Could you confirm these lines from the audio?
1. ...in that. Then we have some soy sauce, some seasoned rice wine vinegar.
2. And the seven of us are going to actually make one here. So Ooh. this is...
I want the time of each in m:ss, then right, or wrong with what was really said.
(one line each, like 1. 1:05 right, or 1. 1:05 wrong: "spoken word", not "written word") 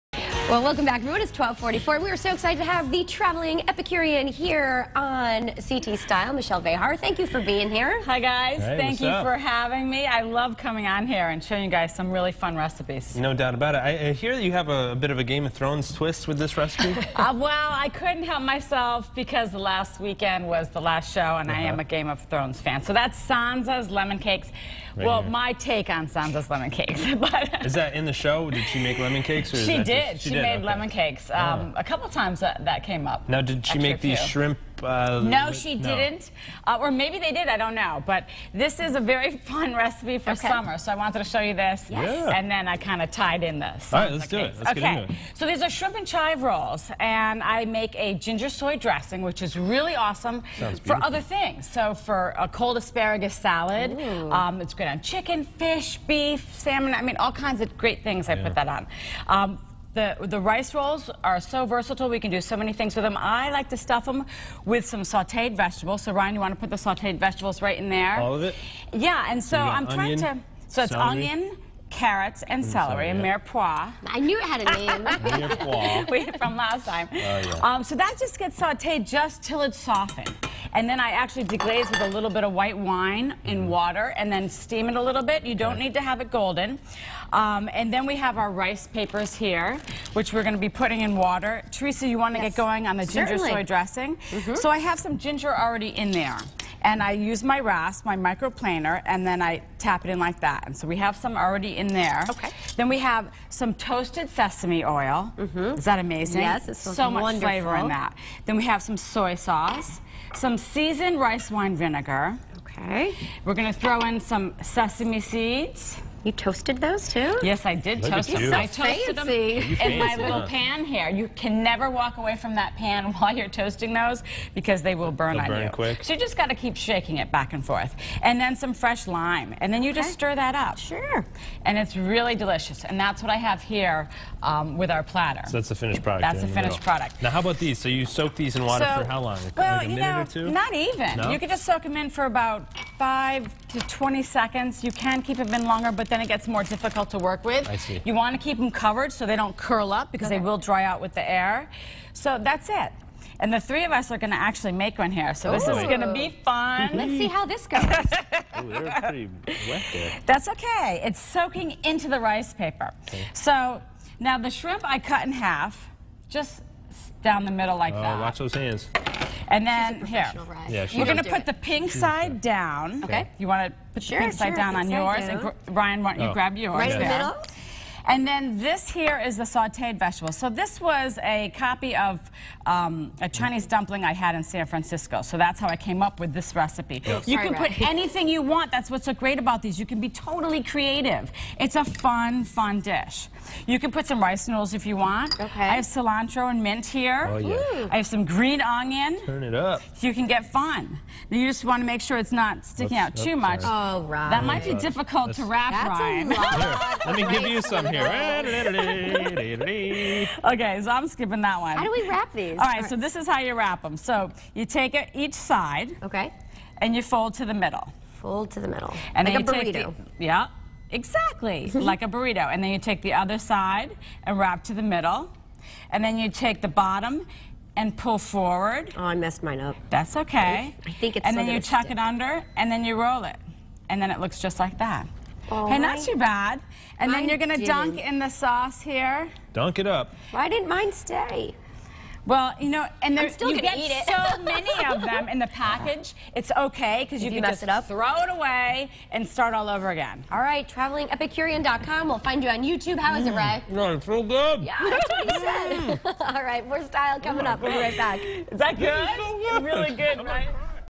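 1. 1:47 right
2. 2:33 wrong: "three", not "seven".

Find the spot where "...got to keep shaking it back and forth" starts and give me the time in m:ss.
2:06.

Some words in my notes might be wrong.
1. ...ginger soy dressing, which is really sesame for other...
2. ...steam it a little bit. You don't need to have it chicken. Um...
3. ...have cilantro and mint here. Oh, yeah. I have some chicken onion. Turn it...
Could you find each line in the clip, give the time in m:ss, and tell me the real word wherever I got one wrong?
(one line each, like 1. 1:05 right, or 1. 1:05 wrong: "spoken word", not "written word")
1. 0:48 wrong: "awesome", not "sesame"
2. 1:24 wrong: "golden", not "chicken"
3. 3:15 wrong: "green", not "chicken".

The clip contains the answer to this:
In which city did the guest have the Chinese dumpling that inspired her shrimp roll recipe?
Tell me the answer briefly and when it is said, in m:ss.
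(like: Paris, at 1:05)
San Francisco, at 3:04.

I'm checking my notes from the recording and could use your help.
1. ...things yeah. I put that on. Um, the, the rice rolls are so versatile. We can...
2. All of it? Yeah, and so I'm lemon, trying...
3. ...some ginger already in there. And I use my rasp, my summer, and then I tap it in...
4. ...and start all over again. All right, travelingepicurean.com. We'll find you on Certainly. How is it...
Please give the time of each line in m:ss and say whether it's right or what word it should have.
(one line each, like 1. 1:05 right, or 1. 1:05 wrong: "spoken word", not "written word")
1. 0:58 right
2. 1:08 wrong: "onion", not "lemon"
3. 1:34 wrong: "microplaner", not "summer"
4. 4:09 wrong: "YouTube", not "Certainly".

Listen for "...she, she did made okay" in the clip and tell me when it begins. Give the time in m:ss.
0:30.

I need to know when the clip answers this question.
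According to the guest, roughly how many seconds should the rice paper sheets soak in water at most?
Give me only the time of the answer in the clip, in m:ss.
2:23.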